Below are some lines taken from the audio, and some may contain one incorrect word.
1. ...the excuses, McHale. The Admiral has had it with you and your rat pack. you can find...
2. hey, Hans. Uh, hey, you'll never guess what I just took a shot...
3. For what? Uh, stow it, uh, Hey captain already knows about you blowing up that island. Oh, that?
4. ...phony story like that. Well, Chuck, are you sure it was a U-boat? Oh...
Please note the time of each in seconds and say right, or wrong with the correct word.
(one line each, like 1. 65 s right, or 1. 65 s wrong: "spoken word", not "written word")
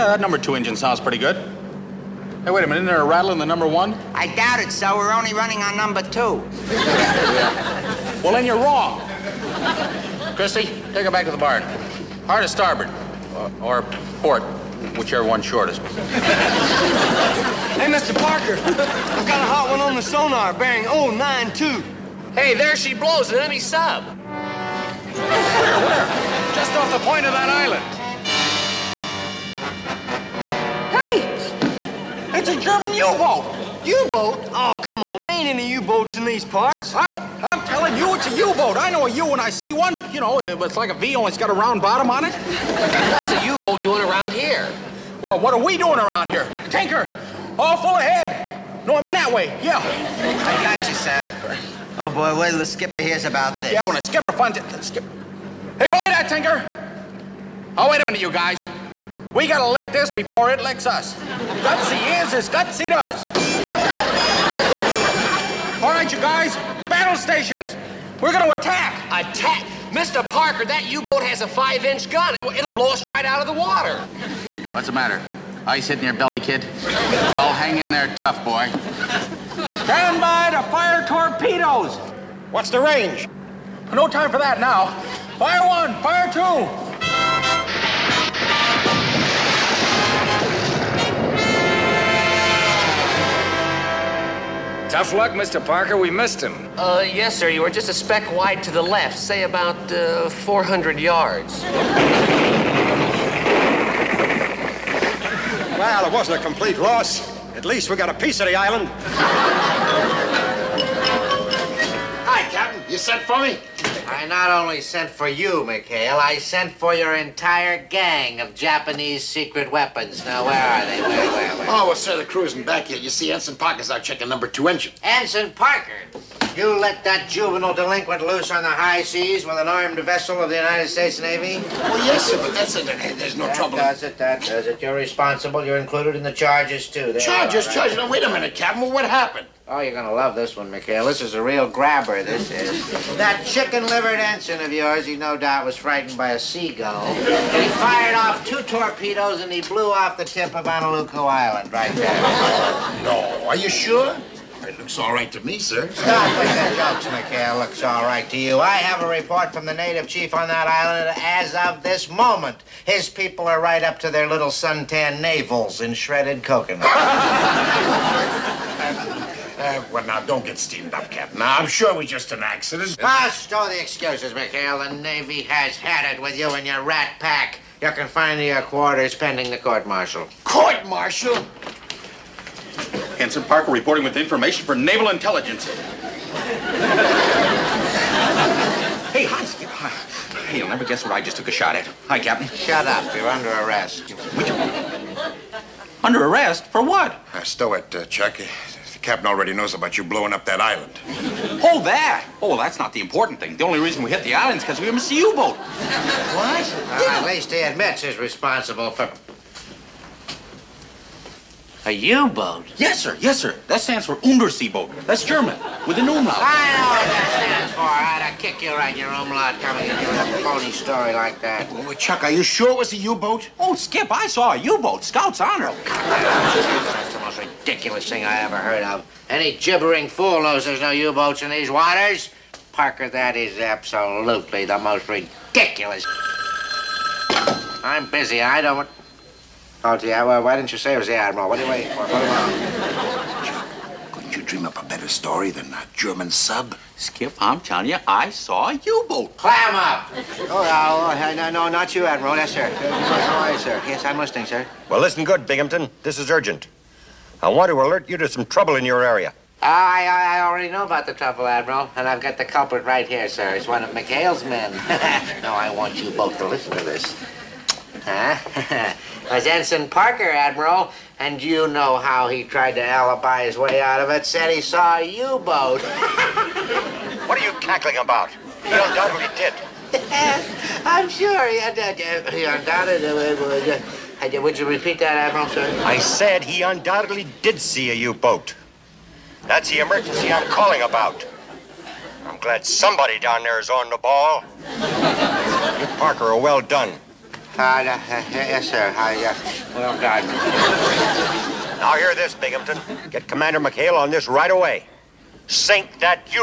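1. 173 s wrong: "Navy", not "Admiral"
2. 185 s right
3. 196 s wrong: "Chuck", not "Hey"
4. 220 s right.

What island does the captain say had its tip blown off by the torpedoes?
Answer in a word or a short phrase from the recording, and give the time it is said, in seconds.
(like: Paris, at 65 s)
Honolulu Island, at 150 s.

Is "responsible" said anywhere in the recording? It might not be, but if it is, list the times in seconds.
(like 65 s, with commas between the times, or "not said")
134 s, 208 s.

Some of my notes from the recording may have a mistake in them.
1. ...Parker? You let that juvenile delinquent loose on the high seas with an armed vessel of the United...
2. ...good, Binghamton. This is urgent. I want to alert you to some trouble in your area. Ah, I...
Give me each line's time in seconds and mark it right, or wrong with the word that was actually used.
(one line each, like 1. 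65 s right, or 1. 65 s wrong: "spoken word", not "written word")
1. 125 s right
2. 255 s right.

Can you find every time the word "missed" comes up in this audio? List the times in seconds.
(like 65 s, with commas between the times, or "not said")
96 s, 204 s.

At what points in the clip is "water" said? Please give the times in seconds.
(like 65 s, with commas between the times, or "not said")
73 s, 231 s.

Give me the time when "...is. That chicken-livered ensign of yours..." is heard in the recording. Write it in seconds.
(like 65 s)
142 s.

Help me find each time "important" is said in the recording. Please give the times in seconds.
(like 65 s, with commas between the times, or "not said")
203 s.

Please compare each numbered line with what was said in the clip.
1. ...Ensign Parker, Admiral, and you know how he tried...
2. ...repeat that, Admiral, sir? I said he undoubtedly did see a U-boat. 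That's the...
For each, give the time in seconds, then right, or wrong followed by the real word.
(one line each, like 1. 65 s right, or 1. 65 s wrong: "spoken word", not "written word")
1. 269 s right
2. 284 s right.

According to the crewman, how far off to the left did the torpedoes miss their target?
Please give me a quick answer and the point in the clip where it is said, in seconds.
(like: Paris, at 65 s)
400 yards, at 100 s.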